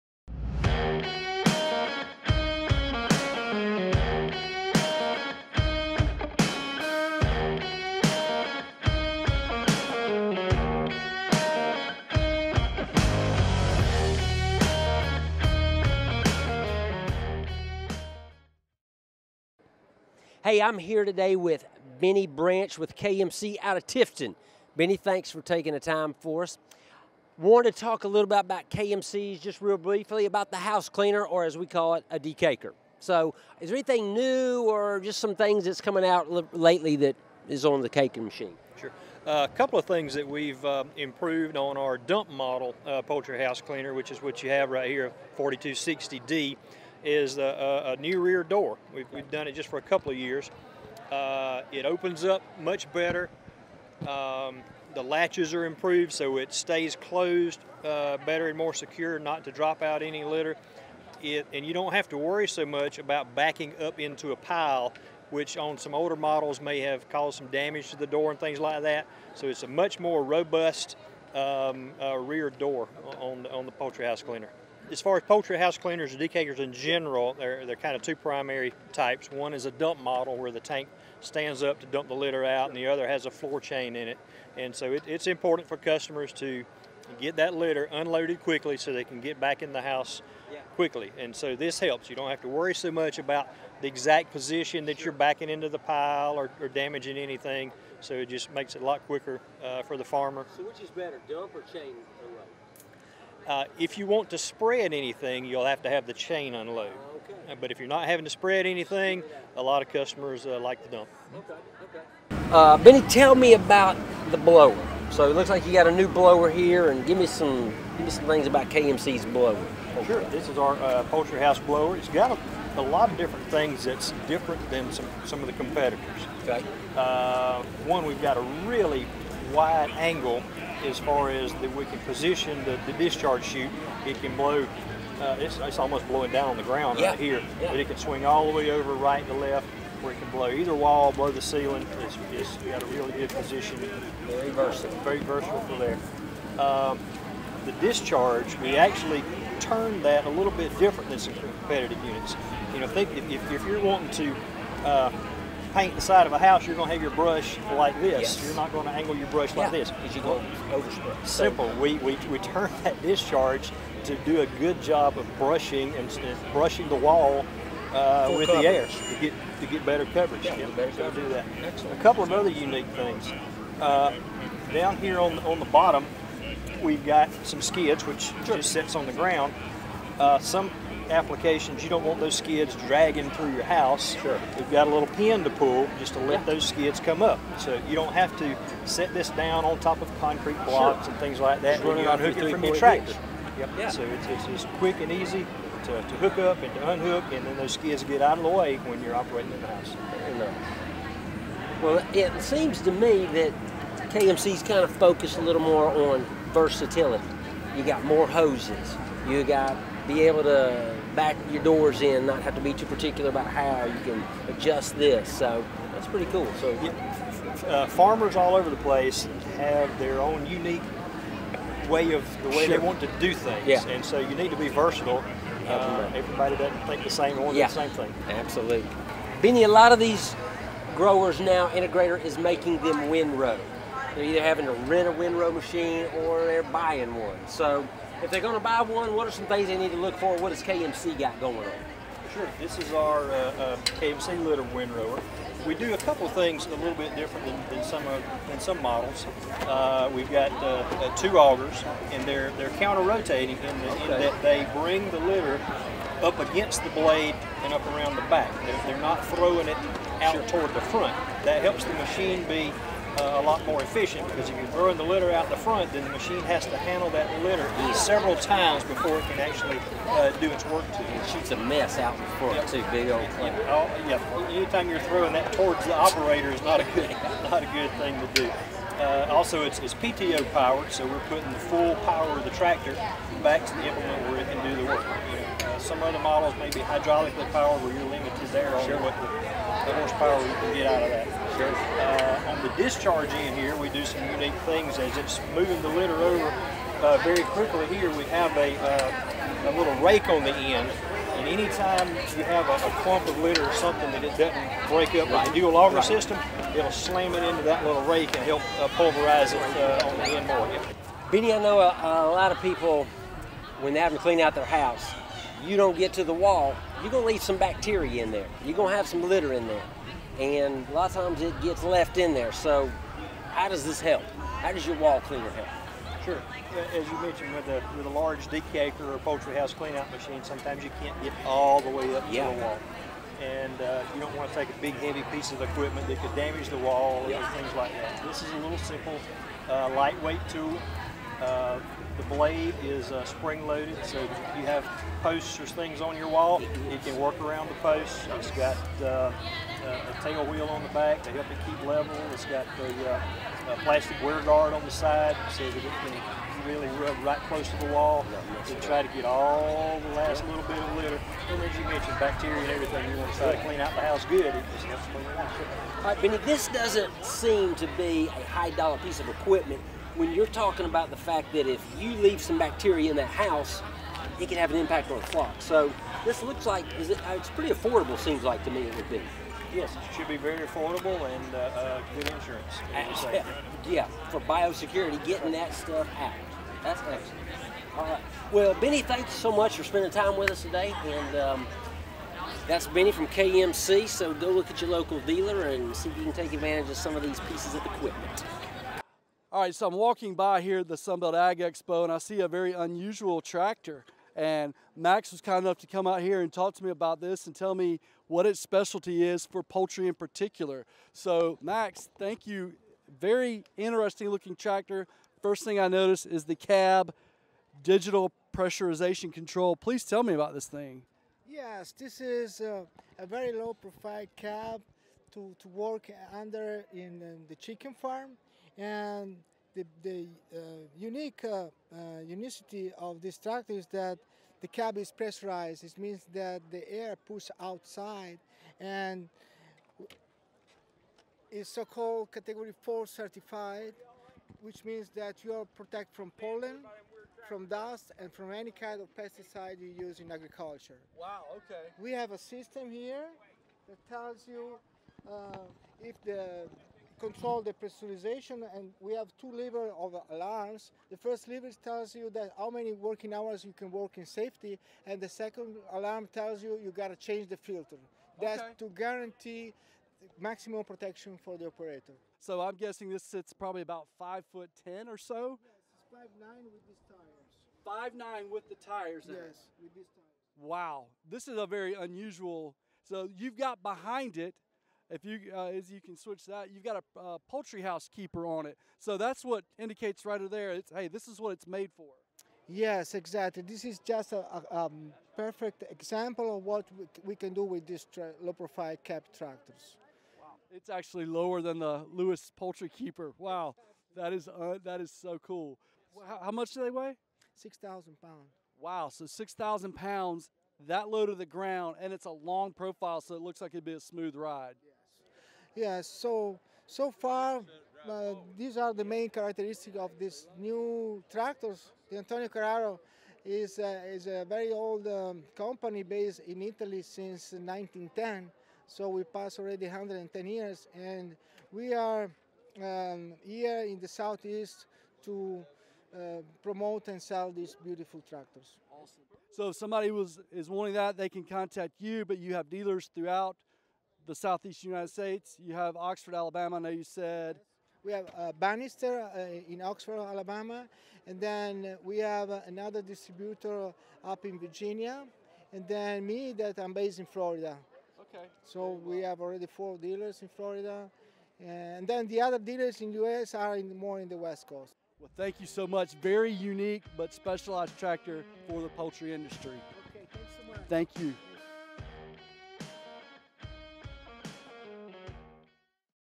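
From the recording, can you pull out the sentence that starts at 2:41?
We, we, we turn that discharge to do a good job of brushing and, brushing the wall uh, with coverage.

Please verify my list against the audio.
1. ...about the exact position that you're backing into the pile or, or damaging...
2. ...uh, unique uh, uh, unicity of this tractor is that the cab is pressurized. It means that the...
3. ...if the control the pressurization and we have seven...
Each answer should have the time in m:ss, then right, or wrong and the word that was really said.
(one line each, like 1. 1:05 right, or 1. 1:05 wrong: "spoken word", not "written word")
1. 1:33 right
2. 7:10 right
3. 7:36 wrong: "two", not "seven".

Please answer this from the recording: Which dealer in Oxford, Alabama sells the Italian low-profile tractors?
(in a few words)
Bannister.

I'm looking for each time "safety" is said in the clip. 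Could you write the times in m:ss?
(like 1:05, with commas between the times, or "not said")
7:44.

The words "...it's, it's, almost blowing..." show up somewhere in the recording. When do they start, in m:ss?
2:15.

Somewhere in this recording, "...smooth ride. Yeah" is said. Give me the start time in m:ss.
8:33.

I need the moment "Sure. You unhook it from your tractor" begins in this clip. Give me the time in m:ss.
3:11.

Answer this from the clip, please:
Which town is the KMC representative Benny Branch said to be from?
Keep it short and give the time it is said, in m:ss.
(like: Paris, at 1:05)
Tifton, at 0:23.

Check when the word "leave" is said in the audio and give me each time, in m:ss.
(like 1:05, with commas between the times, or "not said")
5:17, 6:12.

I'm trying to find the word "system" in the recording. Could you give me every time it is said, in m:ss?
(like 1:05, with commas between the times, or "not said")
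5:06, 7:32.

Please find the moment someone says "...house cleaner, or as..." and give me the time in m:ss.
0:30.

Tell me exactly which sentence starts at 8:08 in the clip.
So that's what indicates right there.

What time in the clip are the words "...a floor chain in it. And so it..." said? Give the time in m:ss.
1:23.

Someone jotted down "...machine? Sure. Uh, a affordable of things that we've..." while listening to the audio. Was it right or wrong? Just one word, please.
wrong.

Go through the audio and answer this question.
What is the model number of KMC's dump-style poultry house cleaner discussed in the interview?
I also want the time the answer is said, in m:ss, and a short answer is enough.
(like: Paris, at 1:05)
4260D, at 0:45.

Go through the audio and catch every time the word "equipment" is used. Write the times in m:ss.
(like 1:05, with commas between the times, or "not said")
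5:35, 6:09, 6:37.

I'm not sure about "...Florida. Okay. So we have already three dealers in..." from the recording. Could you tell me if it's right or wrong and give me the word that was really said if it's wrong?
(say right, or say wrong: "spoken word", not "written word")
wrong: "four", not "three".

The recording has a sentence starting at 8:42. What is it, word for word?
The Antonio Carraro is, uh, is a very old um, company based in Italy since 1910.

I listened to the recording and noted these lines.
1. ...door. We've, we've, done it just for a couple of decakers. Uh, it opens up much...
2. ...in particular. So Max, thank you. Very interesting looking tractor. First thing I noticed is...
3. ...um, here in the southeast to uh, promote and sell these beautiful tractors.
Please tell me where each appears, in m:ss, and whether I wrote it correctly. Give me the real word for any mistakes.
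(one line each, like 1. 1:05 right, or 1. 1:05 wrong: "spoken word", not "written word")
1. 0:48 wrong: "years", not "decakers"
2. 6:50 right
3. 8:52 right.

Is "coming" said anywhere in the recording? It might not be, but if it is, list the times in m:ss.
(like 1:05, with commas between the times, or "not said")
0:35.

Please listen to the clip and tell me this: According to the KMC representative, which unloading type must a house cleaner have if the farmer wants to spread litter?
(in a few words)
Chain unload.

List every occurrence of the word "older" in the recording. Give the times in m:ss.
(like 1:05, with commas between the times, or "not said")
1:05.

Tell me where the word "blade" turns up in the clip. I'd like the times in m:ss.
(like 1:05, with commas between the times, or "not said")
4:16, 5:42.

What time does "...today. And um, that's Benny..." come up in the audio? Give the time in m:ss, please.
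6:30.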